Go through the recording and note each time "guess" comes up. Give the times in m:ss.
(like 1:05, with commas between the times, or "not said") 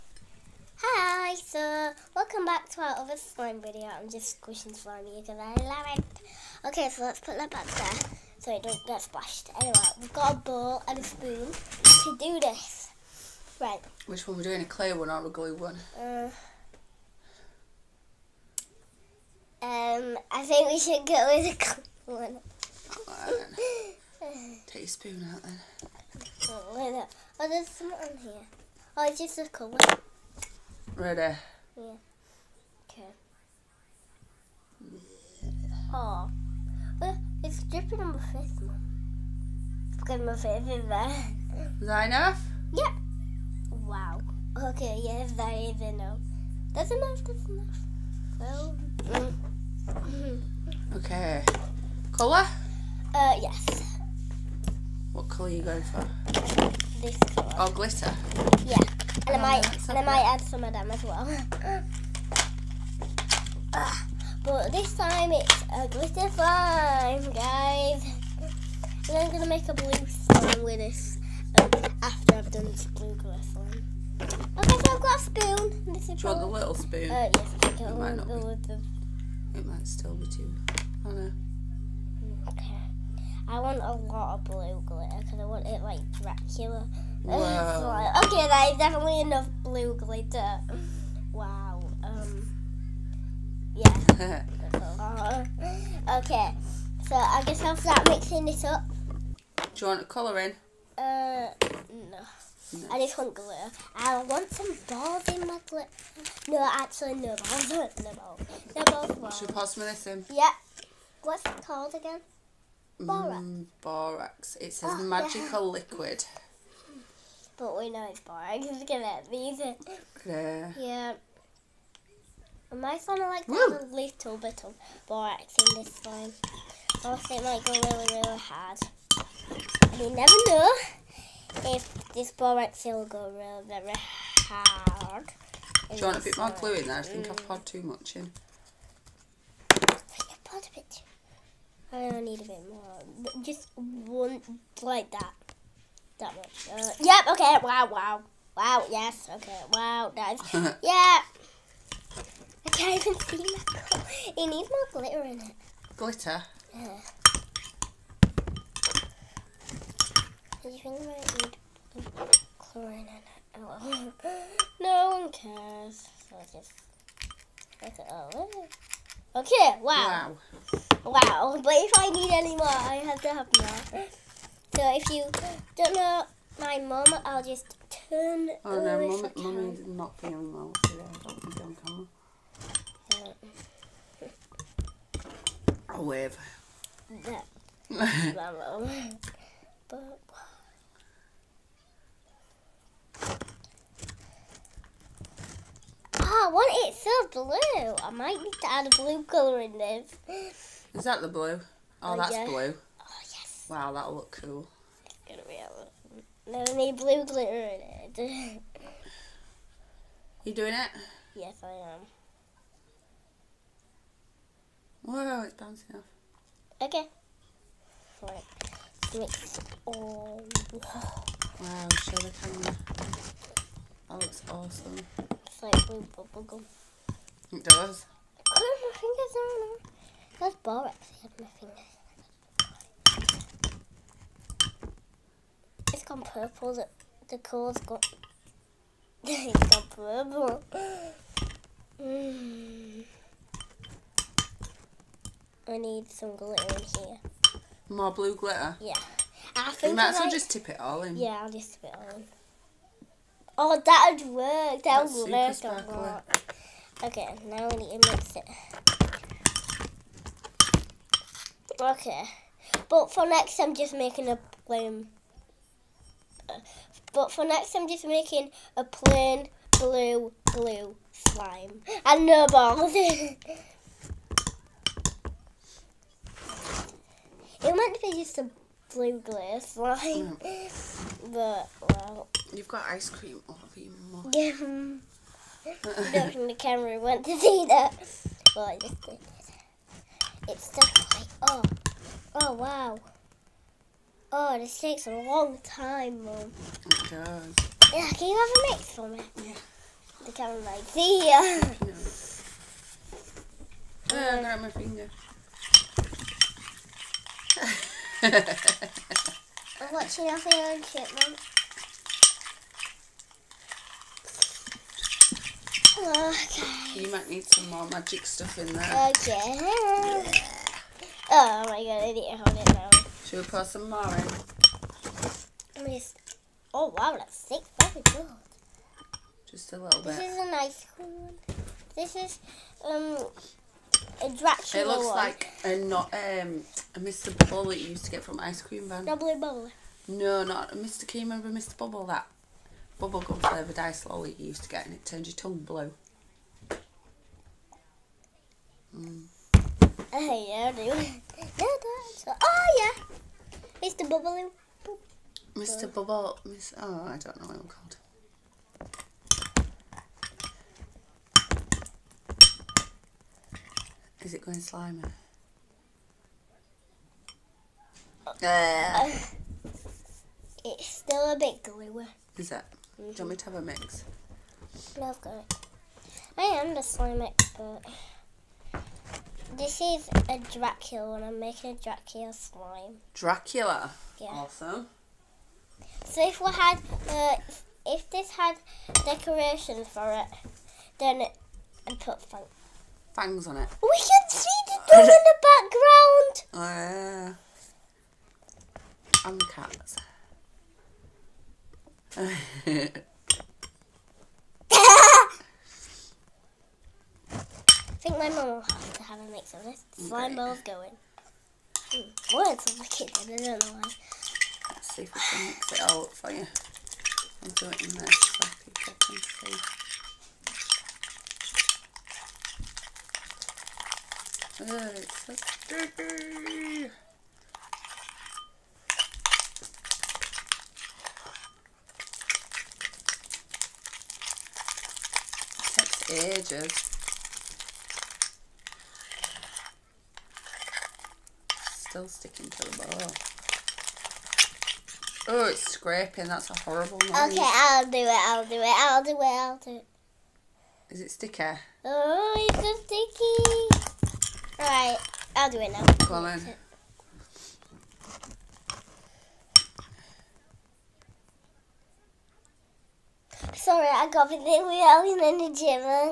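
1:37.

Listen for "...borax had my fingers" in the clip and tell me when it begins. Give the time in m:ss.
3:50.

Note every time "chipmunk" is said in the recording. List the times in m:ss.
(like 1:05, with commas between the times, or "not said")
5:10.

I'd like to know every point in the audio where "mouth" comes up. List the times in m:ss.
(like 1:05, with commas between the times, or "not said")
4:44.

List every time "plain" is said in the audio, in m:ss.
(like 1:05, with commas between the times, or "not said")
4:24, 4:28.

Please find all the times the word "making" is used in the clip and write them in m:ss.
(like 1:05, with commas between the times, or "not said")
4:23, 4:28, 6:21.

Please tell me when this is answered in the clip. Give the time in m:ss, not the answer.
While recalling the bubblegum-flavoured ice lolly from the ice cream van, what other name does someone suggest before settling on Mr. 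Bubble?
5:39.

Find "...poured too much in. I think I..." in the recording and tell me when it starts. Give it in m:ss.
2:17.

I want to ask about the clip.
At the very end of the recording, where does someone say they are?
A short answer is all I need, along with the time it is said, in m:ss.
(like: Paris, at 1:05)
the gym, at 7:45.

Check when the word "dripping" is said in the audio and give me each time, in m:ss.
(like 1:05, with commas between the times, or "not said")
0:37.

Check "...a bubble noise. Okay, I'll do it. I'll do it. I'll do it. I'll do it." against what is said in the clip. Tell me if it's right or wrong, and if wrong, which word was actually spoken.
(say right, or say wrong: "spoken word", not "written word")
wrong: "horrible", not "bubble".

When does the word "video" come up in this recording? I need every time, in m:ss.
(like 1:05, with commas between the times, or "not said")
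0:03.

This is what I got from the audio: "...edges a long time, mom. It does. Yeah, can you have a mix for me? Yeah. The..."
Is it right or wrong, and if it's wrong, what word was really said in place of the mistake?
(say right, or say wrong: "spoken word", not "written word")
wrong: "takes", not "edges".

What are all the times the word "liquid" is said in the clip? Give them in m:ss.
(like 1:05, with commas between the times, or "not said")
1:55.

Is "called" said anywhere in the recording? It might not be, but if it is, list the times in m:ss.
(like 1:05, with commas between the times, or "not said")
1:51, 5:57.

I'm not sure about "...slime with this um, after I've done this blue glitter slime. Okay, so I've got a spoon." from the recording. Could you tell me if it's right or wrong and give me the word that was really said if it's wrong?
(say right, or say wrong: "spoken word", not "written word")
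right.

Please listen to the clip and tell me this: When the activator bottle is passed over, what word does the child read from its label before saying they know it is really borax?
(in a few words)
magical.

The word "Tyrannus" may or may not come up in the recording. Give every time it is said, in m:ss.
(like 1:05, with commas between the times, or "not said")
not said.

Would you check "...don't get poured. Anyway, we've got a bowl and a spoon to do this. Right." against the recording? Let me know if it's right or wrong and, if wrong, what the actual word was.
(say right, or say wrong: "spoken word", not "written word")
wrong: "splashed", not "poured".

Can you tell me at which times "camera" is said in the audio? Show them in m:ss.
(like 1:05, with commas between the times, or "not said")
3:03, 3:42, 4:46, 5:00.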